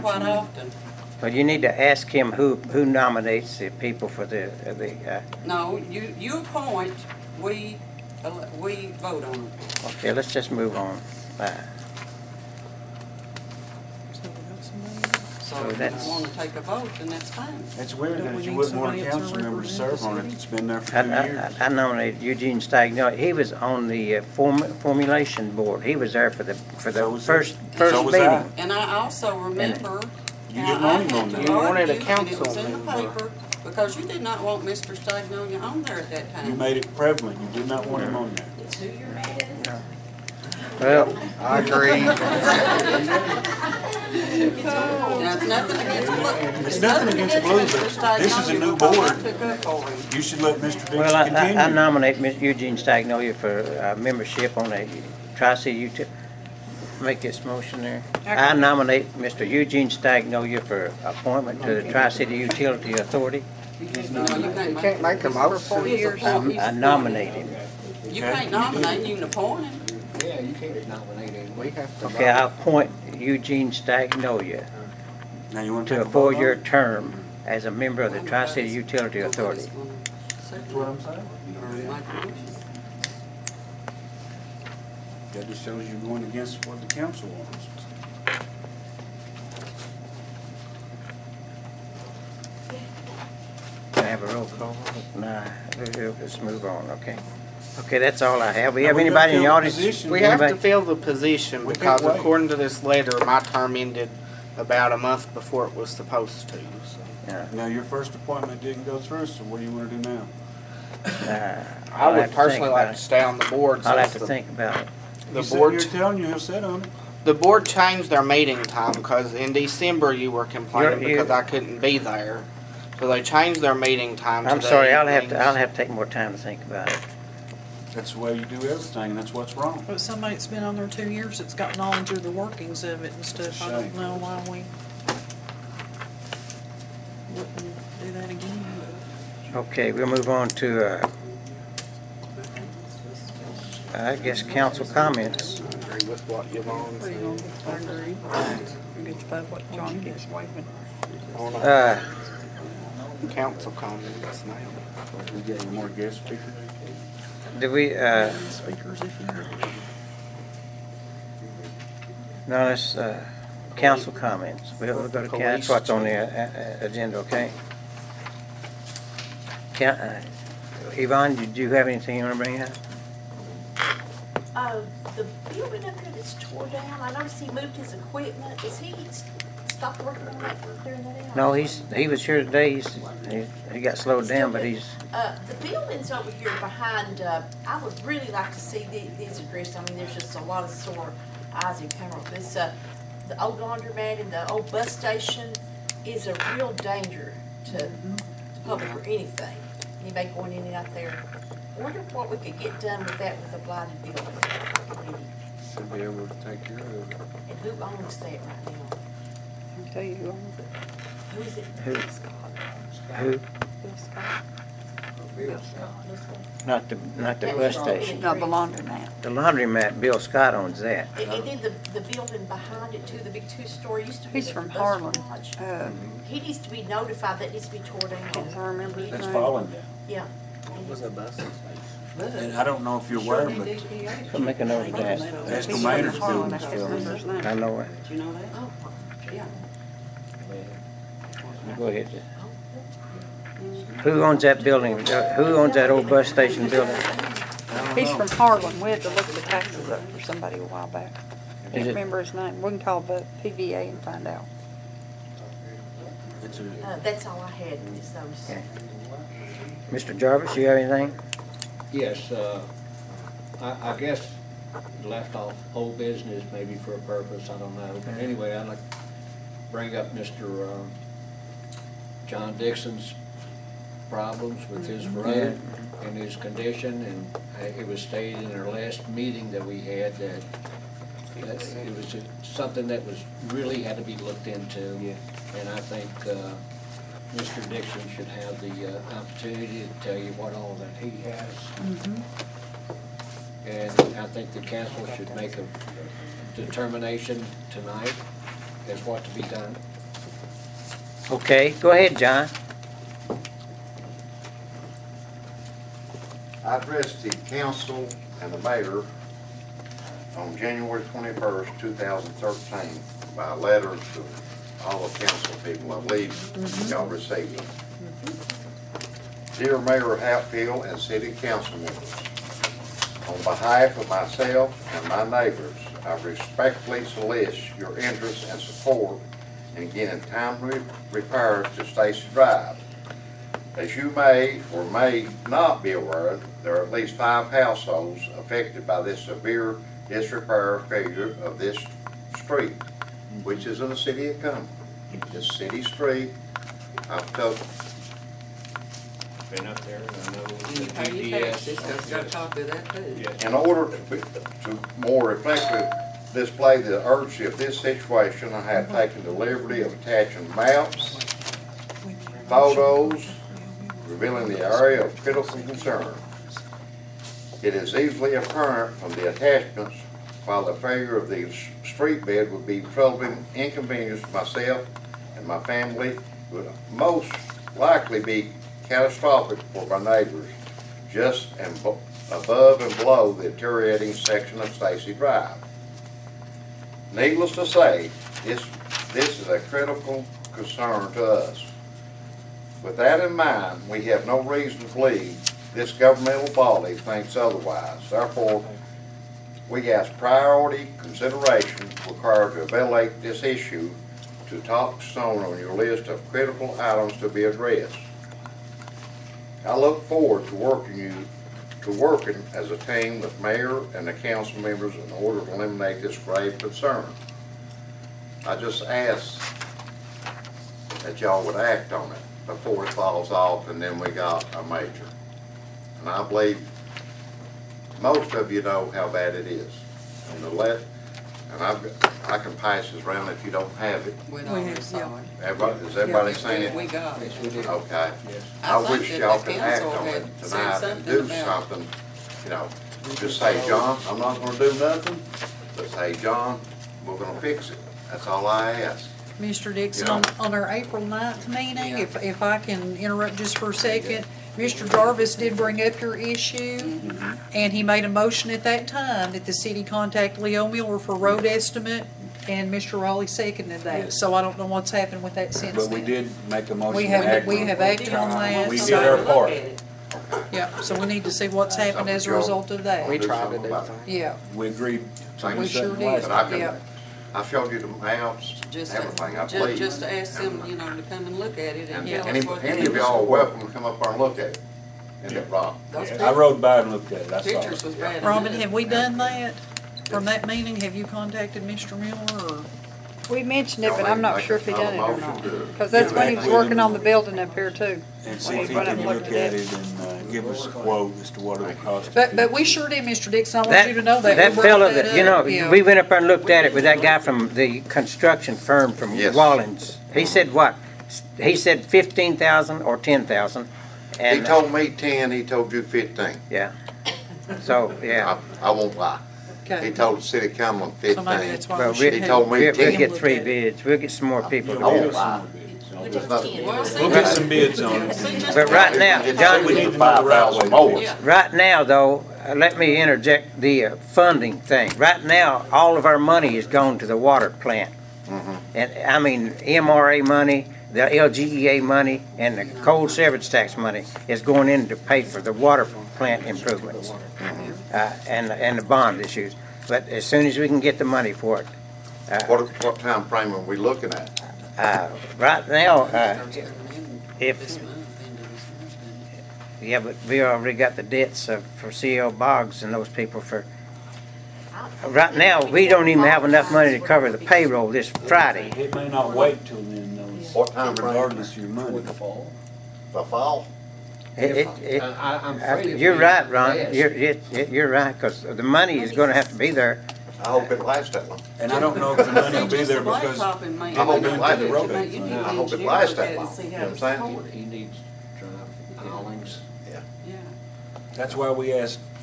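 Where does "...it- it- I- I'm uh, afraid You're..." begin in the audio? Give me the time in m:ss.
9:34.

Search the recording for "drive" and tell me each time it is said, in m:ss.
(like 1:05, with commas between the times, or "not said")
5:32, 6:25, 9:48.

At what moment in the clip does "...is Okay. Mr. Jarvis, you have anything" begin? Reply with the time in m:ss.
4:17.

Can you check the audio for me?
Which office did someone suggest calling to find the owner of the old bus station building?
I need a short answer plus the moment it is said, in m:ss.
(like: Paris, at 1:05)
PVA, at 4:13.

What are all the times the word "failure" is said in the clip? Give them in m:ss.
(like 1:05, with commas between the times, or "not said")
5:40, 6:10.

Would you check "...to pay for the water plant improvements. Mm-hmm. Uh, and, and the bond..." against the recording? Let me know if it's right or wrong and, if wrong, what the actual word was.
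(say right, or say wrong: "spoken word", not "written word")
right.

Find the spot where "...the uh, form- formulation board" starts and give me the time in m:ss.
0:23.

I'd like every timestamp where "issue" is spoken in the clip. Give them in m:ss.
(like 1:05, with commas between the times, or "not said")
6:43, 7:36, 9:09.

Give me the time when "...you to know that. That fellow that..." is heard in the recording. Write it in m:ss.
8:23.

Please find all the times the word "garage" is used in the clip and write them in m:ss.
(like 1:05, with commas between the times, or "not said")
3:45.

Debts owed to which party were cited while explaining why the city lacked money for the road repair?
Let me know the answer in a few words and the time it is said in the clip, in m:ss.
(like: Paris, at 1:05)
C.L. Boggs, at 9:21.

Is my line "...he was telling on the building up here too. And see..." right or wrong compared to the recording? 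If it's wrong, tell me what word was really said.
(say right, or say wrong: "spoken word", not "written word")
wrong: "working", not "telling".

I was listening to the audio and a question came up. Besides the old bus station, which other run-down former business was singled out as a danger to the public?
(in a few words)
the old laundromat.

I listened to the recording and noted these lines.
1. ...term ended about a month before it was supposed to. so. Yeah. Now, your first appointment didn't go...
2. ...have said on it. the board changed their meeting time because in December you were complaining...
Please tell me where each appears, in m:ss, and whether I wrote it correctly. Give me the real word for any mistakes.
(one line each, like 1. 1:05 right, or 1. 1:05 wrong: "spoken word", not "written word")
1. 1:43 right
2. 1:56 right.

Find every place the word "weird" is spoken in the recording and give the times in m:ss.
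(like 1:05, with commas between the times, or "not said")
0:17.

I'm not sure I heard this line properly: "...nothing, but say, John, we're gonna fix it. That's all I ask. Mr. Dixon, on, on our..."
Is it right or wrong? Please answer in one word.
right.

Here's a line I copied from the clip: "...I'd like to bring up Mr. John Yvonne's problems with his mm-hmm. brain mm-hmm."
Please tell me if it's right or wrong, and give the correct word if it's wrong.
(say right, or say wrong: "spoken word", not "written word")
wrong: "Dixon", not "Yvonne".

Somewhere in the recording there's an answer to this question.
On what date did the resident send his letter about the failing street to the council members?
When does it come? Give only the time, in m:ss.
5:10.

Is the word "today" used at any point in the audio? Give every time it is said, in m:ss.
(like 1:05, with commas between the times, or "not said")
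3:02.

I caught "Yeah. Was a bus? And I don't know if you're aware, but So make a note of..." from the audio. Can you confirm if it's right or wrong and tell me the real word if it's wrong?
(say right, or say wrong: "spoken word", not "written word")
right.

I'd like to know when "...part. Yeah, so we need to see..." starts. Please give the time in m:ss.
7:49.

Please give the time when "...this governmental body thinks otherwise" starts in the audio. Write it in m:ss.
6:35.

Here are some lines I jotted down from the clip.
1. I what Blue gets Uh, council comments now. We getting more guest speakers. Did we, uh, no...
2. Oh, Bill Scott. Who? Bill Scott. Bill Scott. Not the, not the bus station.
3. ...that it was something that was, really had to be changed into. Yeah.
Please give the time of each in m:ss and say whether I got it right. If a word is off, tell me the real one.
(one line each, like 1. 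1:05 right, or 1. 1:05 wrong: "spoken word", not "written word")
1. 2:29 wrong: "John", not "Blue"
2. 3:31 right
3. 4:40 wrong: "looked", not "changed".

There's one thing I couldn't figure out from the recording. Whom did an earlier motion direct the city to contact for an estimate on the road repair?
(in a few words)
Leo Miller.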